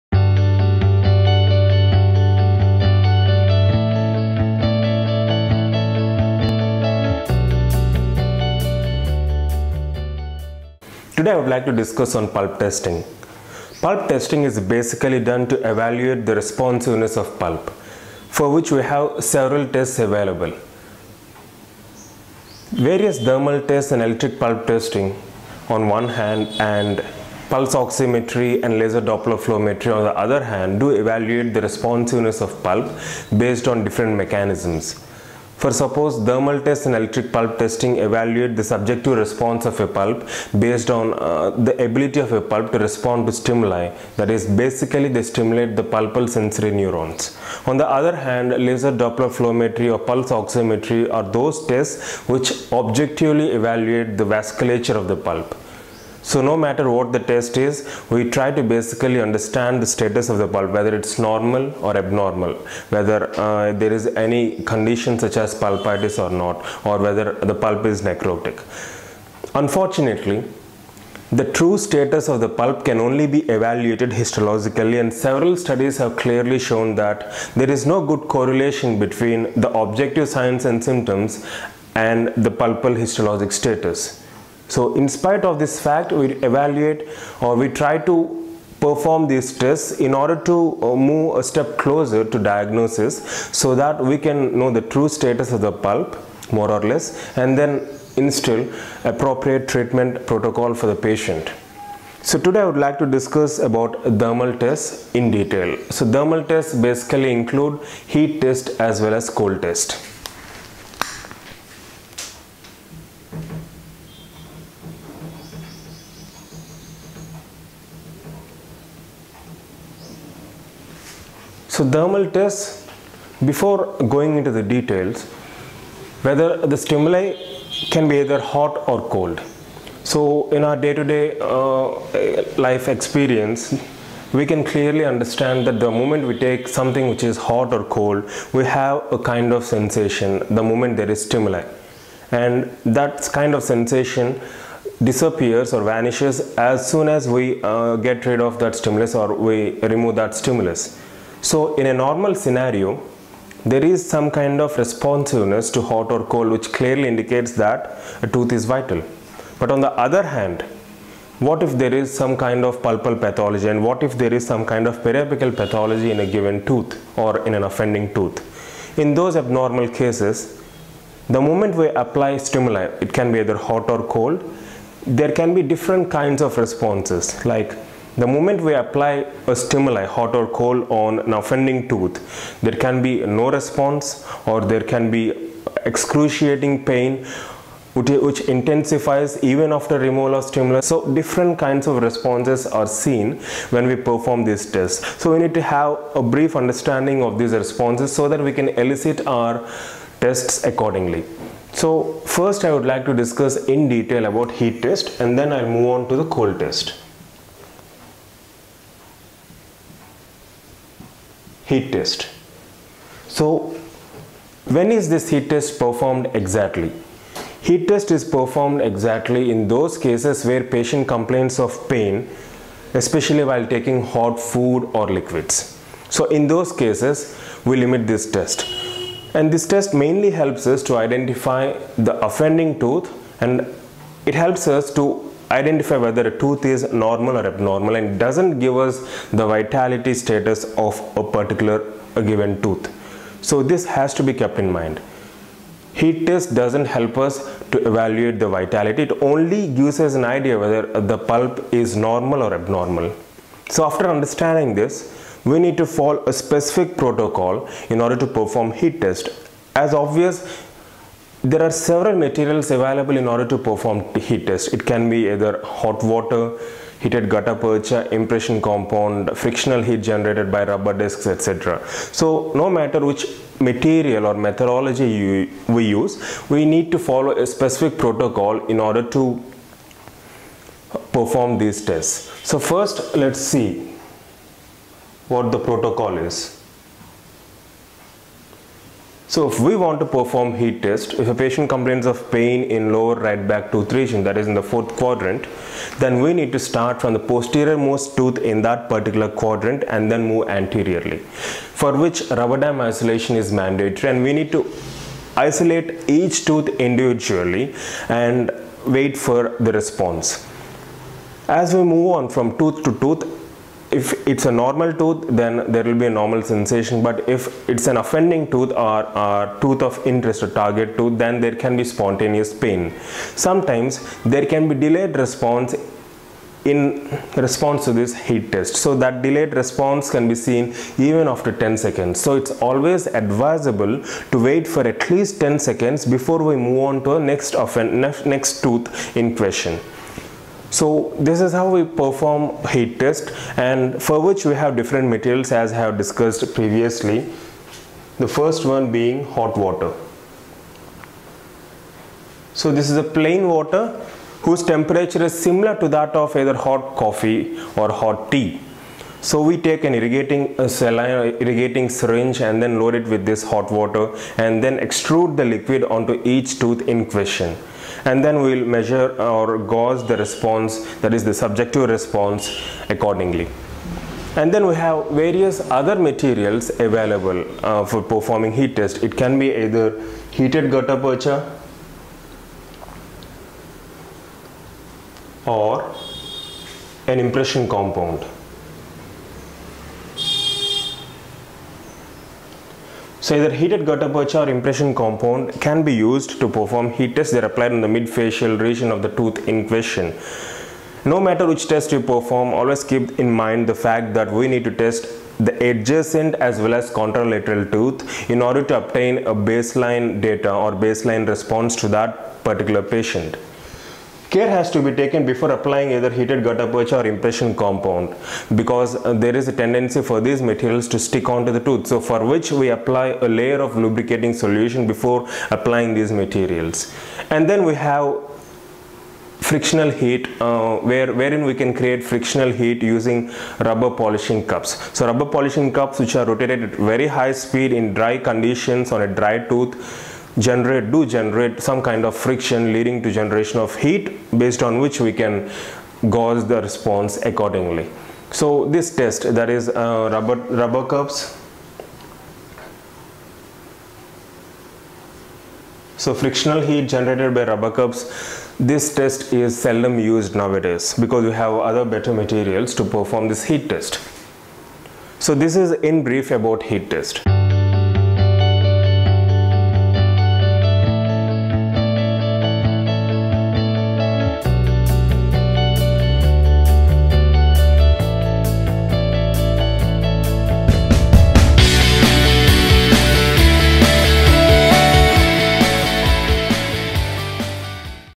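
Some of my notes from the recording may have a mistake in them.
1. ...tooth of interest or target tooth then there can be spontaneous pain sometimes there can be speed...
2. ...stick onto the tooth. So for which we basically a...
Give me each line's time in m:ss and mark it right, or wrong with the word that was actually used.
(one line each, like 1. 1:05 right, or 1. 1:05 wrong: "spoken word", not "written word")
1. 5:19 wrong: "delayed", not "speed"
2. 7:00 wrong: "apply", not "basically".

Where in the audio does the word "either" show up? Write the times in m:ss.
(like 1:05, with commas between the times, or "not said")
2:08, 2:53, 4:25, 5:56, 6:19, 6:33, 6:55.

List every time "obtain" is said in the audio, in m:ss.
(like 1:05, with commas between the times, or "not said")
6:48.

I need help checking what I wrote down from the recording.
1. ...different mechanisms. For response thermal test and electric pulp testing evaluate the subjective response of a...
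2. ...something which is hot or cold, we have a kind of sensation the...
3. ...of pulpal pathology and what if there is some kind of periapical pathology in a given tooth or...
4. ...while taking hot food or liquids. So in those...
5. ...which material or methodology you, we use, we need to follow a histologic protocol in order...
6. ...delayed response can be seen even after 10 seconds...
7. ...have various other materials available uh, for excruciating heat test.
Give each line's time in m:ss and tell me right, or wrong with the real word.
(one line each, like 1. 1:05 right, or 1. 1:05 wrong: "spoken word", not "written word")
1. 0:33 wrong: "suppose", not "response"
2. 2:16 right
3. 2:42 right
4. 3:43 right
5. 4:33 wrong: "specific", not "histologic"
6. 5:29 right
7. 6:14 wrong: "performing", not "excruciating".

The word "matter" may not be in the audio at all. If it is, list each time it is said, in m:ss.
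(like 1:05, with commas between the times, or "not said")
0:56, 4:32, 6:41.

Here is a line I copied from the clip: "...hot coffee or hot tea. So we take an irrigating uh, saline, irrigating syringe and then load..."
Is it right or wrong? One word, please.
right.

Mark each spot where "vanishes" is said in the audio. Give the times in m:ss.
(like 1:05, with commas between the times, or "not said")
2:25.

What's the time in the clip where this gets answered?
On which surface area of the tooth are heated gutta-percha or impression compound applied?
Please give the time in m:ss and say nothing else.
6:37.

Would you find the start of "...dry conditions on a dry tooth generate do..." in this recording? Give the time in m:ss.
7:17.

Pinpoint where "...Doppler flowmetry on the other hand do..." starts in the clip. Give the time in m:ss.
0:29.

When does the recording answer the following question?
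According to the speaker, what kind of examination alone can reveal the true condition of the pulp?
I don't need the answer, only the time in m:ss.
1:14.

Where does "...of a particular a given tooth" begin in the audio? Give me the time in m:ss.
4:00.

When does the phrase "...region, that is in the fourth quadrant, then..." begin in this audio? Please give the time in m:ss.
4:53.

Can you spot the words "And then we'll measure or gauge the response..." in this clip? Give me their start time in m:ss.
6:08.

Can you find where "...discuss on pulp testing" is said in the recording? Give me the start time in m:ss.
0:11.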